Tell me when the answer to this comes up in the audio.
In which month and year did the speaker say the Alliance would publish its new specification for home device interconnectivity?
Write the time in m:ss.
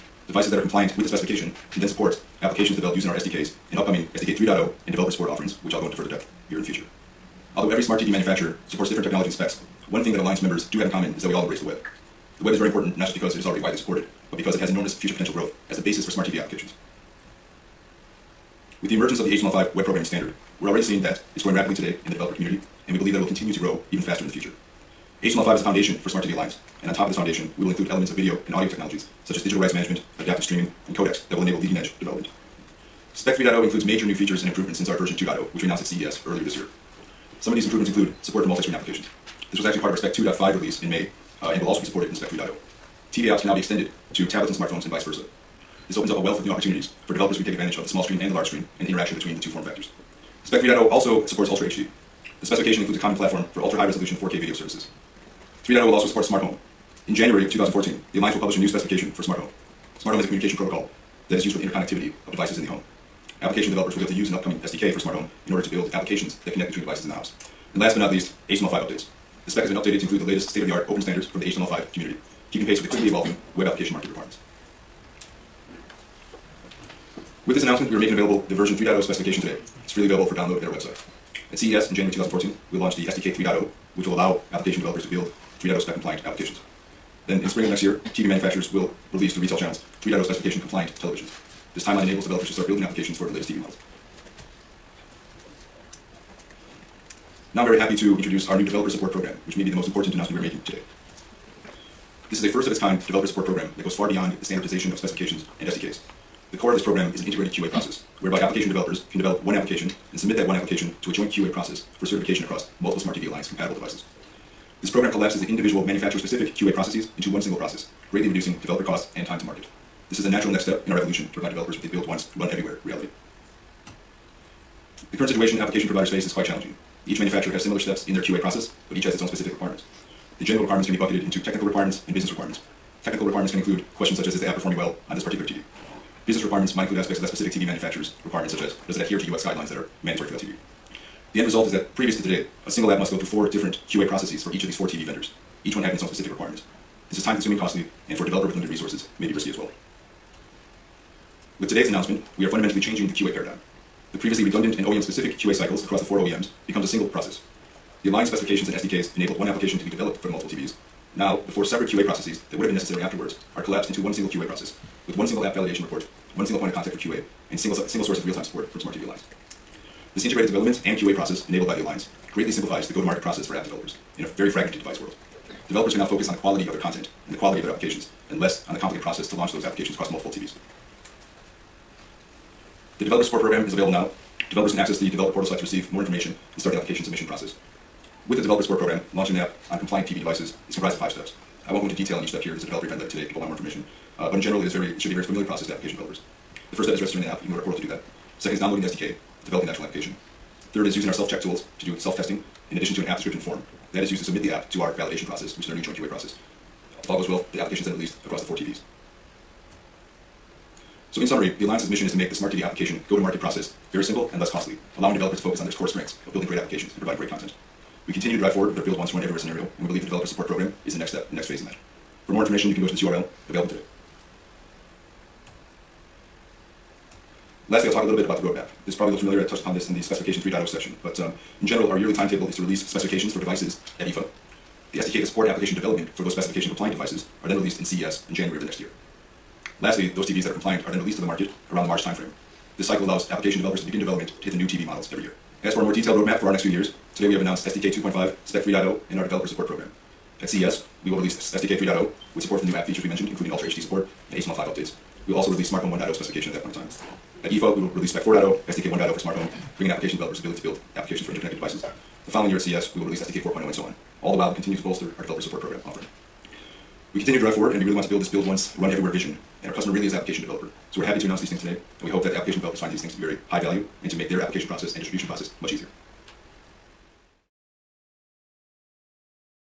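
0:57.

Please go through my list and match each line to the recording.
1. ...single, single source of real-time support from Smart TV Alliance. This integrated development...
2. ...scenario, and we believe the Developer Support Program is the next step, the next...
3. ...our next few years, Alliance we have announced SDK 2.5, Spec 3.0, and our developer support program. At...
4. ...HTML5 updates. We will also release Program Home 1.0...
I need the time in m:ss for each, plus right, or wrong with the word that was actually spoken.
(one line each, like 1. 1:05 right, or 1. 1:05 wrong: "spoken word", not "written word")
1. 2:47 right
2. 3:39 right
3. 4:06 wrong: "Today", not "Alliance"
4. 4:14 wrong: "Smart", not "Program".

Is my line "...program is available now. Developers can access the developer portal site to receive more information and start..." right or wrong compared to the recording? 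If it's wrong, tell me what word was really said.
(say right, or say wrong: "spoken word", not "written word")
right.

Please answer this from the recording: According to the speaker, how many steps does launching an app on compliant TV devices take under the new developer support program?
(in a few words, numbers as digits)
5.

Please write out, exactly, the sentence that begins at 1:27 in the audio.
Then in spring of next year, TV manufacturers will release through retail channels 3.0 specification compliant televisions.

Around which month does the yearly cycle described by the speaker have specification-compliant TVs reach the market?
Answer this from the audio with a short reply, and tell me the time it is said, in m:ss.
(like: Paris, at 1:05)
March, at 4:01.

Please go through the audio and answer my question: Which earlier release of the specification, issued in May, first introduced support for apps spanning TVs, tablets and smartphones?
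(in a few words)
Spec 2.5.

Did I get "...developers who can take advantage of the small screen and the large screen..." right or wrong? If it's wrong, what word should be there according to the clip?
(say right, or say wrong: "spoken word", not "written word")
right.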